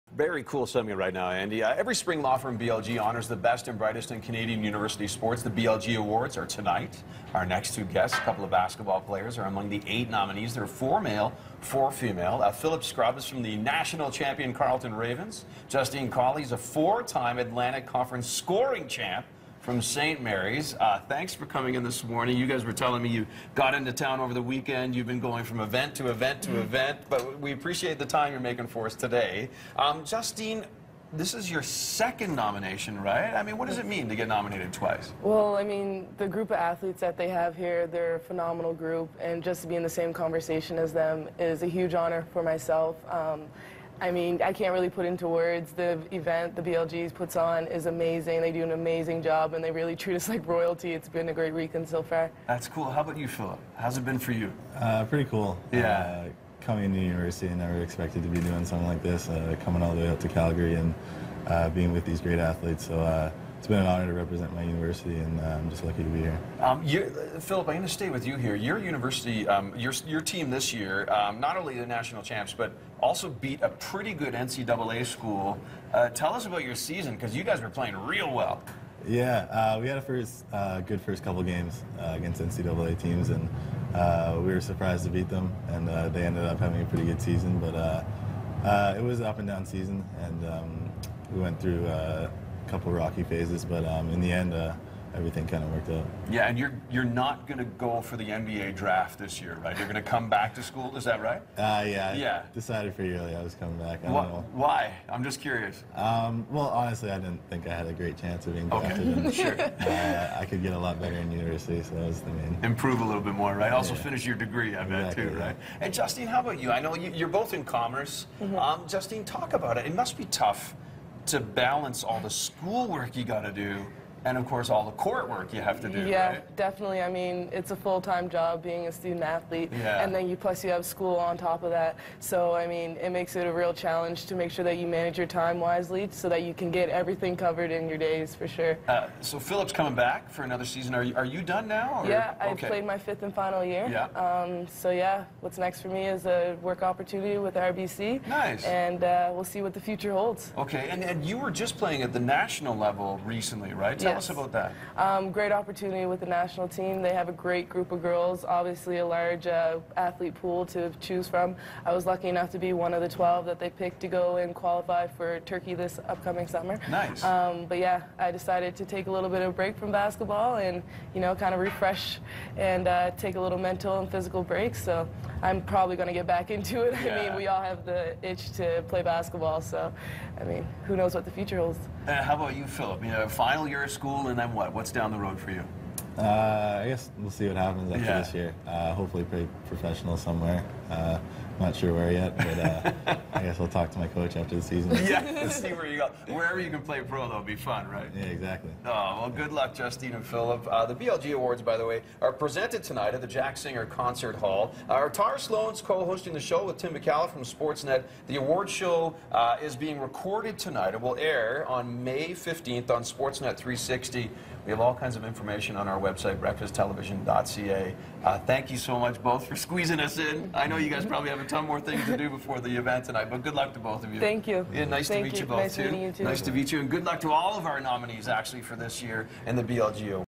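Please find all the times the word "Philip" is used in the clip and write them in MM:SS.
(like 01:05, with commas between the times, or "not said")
00:12, 00:53, 01:06, 02:19, 03:02, 03:20.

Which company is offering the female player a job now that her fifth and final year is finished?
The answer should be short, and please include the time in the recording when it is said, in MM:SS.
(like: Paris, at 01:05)
RBC, at 02:27.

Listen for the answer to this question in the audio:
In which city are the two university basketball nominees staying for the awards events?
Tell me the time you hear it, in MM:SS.
01:00.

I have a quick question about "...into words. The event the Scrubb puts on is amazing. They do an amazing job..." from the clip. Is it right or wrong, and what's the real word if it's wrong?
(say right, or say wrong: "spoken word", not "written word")
wrong: "BLGs", not "Scrubb".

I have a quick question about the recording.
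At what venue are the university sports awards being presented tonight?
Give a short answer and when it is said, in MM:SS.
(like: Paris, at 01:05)
Jack Singer Concert Hall, at 03:23.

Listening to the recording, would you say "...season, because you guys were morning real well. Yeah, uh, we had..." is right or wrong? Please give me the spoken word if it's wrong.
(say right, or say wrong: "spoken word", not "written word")
wrong: "playing", not "morning".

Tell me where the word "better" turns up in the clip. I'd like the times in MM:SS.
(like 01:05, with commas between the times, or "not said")
01:51.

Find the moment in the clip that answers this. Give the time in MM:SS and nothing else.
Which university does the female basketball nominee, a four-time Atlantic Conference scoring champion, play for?
00:19.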